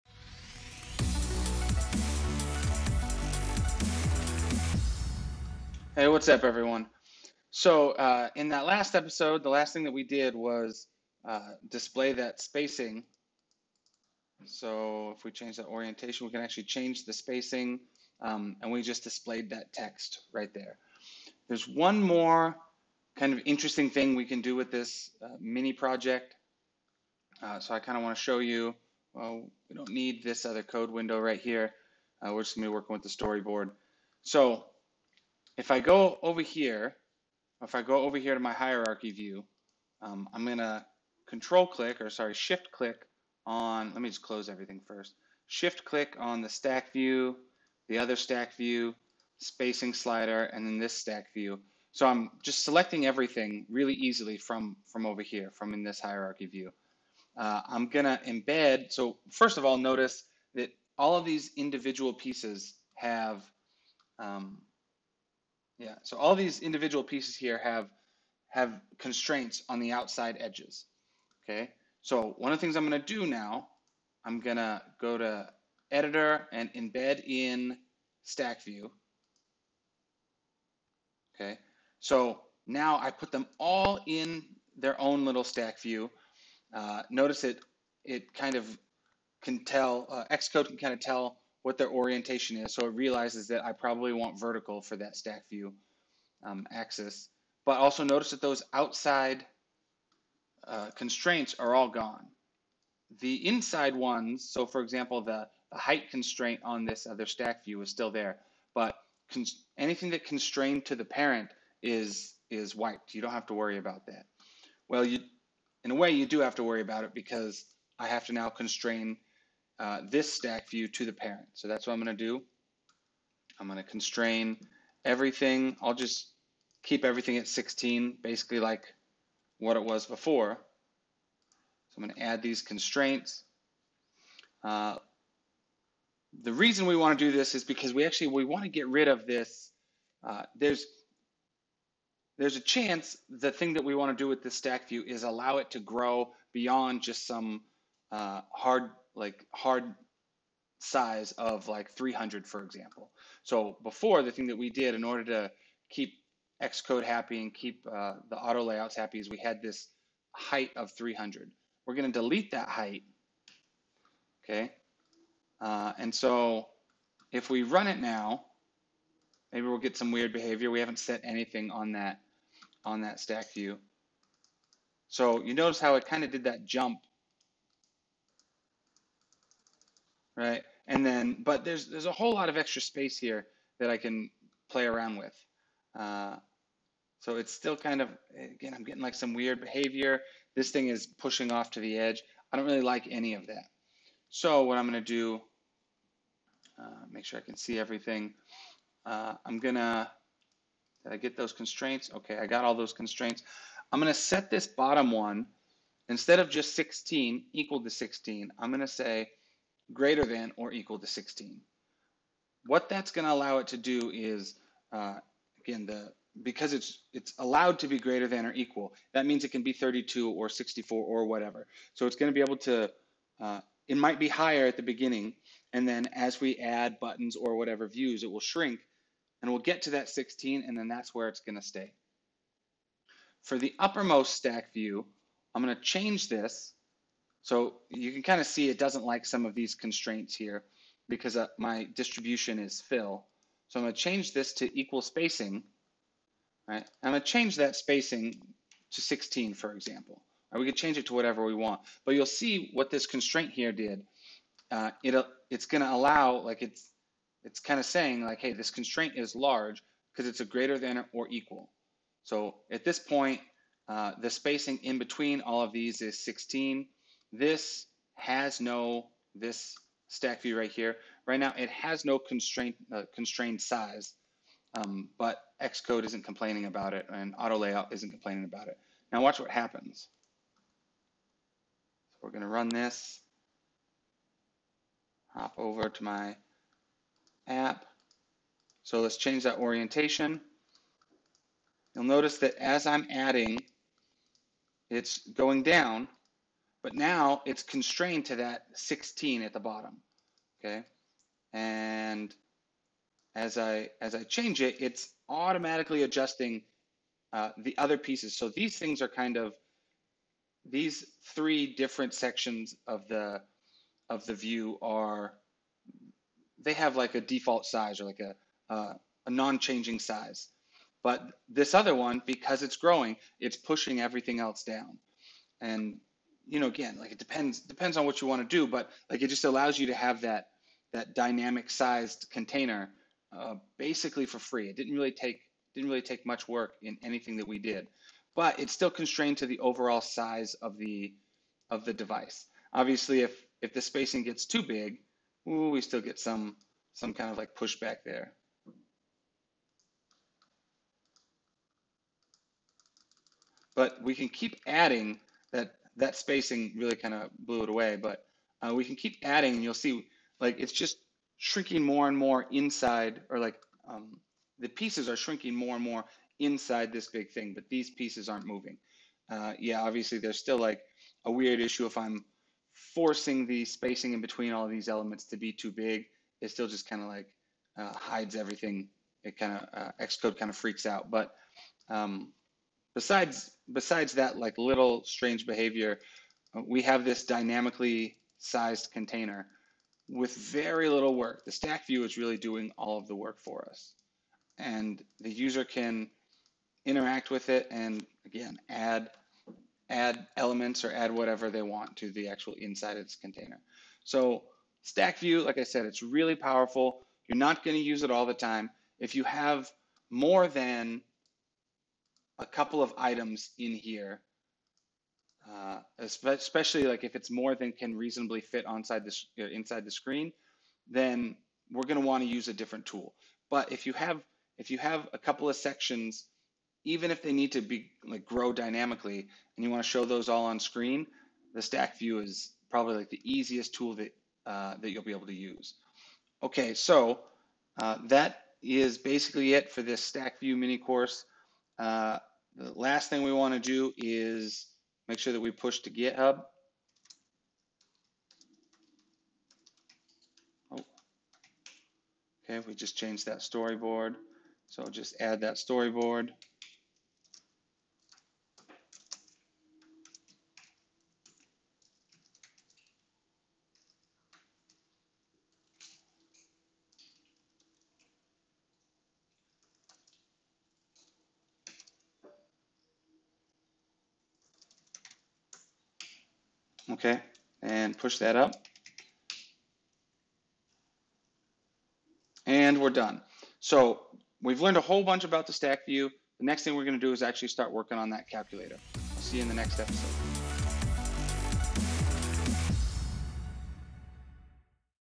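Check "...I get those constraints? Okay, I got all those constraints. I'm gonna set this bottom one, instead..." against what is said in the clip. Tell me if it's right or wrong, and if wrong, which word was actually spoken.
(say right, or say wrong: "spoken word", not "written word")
right.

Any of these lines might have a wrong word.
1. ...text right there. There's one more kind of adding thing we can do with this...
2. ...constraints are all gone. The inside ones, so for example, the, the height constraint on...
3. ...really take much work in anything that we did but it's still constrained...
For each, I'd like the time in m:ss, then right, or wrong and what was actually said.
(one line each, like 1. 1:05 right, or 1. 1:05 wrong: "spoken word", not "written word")
1. 0:19 wrong: "interesting", not "adding"
2. 1:40 right
3. 5:35 right.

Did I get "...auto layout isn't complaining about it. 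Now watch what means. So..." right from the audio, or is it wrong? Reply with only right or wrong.
wrong.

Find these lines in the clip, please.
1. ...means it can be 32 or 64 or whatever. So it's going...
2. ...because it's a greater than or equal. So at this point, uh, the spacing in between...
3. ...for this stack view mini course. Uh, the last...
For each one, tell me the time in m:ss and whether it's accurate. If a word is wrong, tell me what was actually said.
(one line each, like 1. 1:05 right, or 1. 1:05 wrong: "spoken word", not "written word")
1. 3:39 right
2. 4:20 right
3. 7:19 right.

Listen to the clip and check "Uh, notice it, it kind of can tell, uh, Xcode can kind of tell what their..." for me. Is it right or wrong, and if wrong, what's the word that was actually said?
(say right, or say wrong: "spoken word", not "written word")
right.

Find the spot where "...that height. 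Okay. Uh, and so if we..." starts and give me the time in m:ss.
2:42.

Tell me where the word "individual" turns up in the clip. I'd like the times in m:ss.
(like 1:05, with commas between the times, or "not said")
1:01, 1:06.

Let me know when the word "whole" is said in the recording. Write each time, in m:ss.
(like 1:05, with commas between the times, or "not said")
3:02, 8:04.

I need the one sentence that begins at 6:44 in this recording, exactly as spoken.
So stack view, like I said, it's really powerful.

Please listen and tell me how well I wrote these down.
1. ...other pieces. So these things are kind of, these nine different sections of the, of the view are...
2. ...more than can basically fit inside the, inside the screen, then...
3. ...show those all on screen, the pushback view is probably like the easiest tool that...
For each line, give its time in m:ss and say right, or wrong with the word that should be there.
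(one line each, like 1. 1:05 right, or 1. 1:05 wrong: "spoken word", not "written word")
1. 5:07 wrong: "three", not "nine"
2. 6:57 wrong: "reasonably", not "basically"
3. 7:09 wrong: "stack", not "pushback".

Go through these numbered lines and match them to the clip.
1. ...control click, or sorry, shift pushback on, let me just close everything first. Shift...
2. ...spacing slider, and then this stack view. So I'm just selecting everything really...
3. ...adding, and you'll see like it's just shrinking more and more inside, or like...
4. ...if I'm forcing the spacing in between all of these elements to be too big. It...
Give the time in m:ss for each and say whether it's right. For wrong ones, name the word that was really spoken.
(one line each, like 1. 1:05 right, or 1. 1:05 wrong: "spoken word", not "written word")
1. 0:41 wrong: "click", not "pushback"
2. 0:49 right
3. 5:59 right
4. 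6:11 right.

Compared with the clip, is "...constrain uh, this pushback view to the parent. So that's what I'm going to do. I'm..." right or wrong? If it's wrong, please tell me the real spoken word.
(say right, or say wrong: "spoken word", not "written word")
wrong: "stack", not "pushback".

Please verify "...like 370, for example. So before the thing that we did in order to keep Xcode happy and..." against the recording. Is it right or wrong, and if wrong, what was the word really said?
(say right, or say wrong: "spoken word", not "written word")
wrong: "300", not "370".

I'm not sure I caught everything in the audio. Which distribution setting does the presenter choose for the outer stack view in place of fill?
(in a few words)
Equal spacing.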